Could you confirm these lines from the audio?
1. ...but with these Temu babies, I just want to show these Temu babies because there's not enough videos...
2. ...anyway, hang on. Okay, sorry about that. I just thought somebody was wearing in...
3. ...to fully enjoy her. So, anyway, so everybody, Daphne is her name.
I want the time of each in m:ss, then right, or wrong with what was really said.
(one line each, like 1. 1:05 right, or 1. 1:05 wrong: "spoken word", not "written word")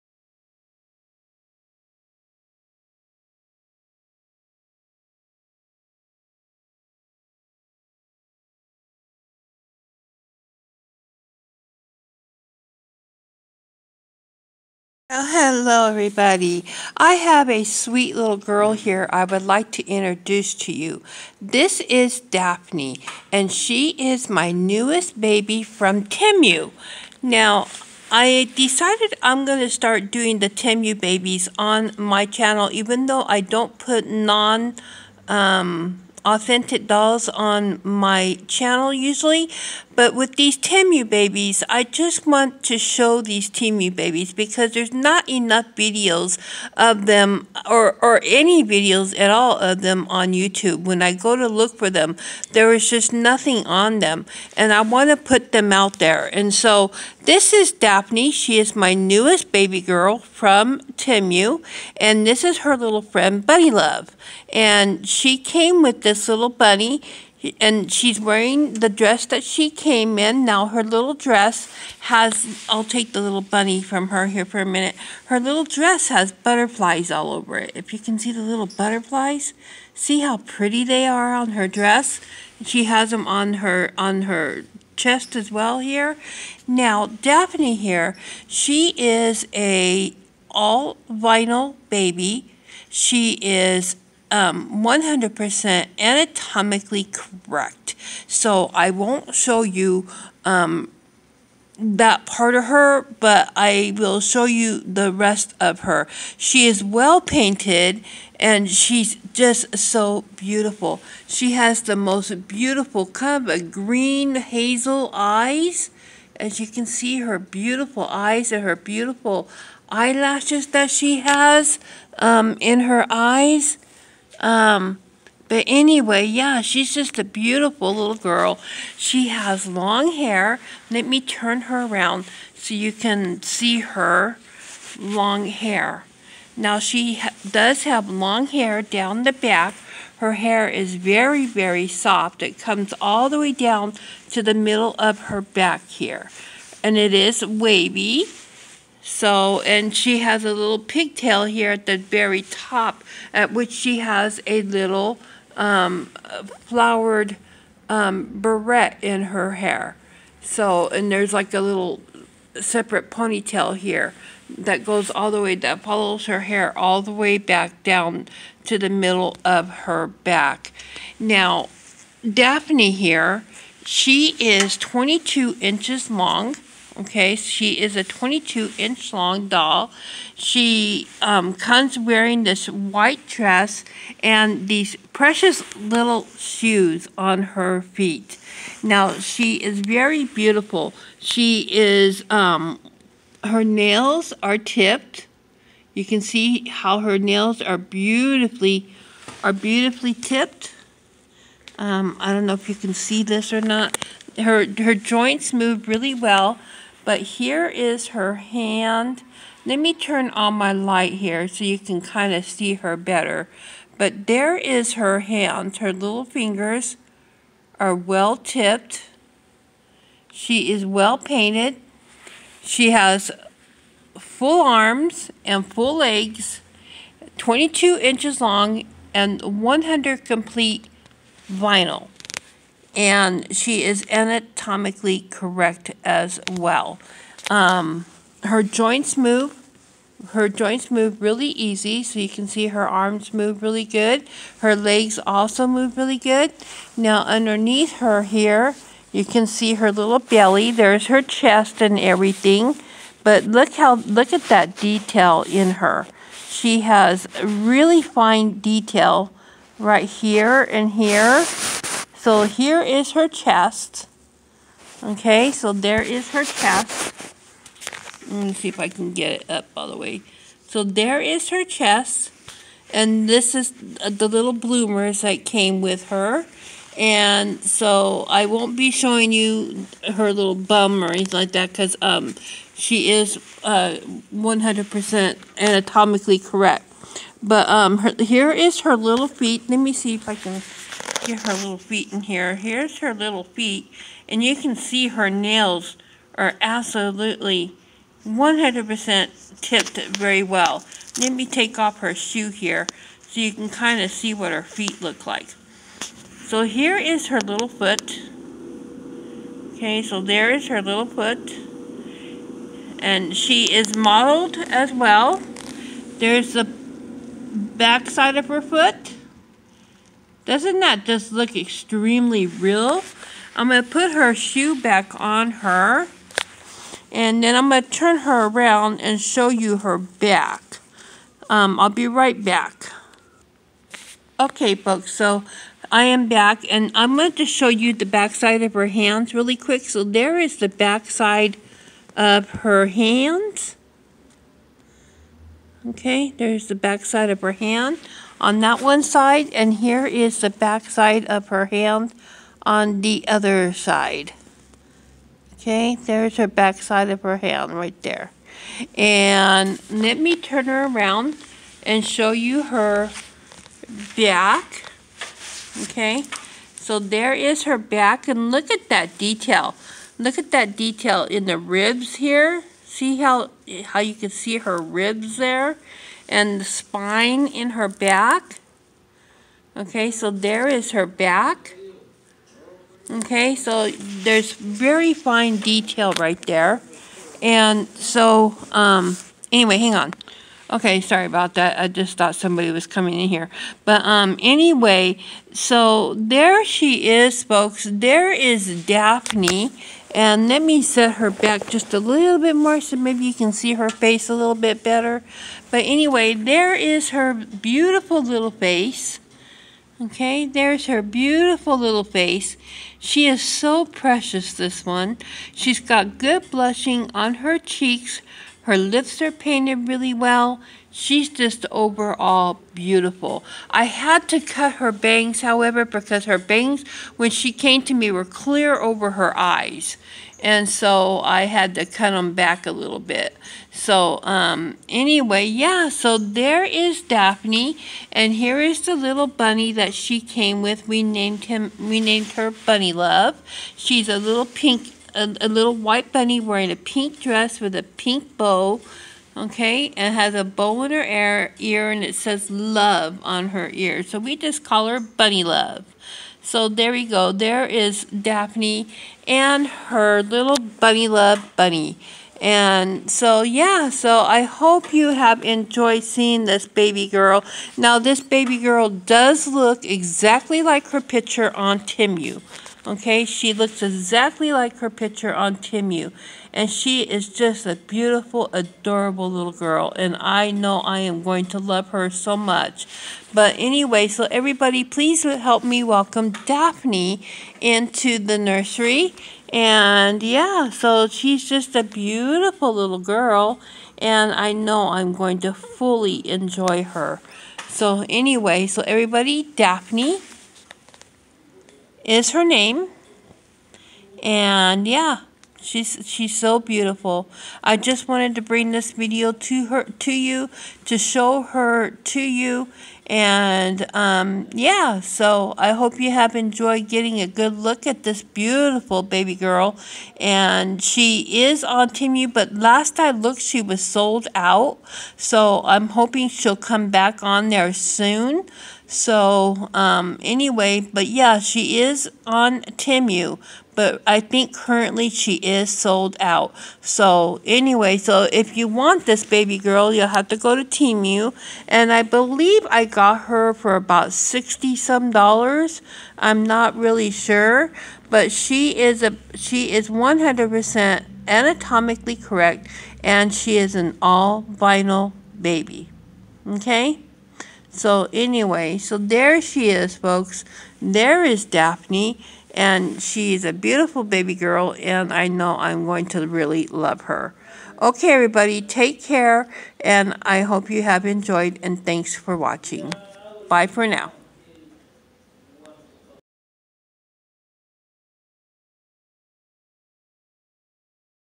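1. 0:39 right
2. 6:29 wrong: "coming", not "wearing"
3. 8:15 right.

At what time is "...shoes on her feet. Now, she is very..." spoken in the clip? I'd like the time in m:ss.
3:06.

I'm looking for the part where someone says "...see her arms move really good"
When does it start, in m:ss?
4:02.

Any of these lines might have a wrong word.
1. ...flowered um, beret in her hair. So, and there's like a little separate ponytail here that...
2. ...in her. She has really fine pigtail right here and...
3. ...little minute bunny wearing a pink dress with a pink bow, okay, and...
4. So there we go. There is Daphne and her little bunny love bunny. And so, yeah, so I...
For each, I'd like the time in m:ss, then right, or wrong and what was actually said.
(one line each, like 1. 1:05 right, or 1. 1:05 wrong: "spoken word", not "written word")
1. 2:36 right
2. 4:15 wrong: "detail", not "pigtail"
3. 7:25 wrong: "white", not "minute"
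4. 7:36 right.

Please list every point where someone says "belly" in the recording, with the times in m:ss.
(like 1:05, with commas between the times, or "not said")
4:10.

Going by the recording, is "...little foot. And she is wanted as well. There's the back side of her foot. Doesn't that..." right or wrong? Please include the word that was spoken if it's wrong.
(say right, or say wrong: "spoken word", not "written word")
wrong: "modeled", not "wanted".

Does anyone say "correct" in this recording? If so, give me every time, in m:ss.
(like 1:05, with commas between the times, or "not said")
1:37, 3:55, 4:46, 9:12.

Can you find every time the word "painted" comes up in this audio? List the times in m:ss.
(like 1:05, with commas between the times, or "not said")
1:47, 3:41, 6:59.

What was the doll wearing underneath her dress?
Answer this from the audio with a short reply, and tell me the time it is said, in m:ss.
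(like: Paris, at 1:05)
Bloomers, at 4:34.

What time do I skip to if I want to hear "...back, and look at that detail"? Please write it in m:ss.
6:07.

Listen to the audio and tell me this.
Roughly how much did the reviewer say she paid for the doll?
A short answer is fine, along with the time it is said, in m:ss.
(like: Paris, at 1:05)
About $60, at 9:04.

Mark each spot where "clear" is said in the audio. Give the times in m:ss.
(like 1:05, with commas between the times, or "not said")
7:08.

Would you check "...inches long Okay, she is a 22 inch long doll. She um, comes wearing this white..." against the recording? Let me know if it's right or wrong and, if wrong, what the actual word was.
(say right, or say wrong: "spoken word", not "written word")
right.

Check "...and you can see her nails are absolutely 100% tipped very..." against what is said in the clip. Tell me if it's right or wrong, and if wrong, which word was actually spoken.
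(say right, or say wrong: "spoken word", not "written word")
right.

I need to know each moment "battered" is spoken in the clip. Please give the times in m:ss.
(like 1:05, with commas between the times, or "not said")
not said.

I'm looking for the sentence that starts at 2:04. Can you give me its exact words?
Um, but anyway, yeah, she's just a beautiful little girl.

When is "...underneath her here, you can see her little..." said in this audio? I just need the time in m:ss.
4:07.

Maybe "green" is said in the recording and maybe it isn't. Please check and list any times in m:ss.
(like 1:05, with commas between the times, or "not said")
1:53.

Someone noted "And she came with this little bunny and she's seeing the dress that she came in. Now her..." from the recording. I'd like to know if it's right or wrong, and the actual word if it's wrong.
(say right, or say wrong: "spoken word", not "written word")
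wrong: "wearing", not "seeing".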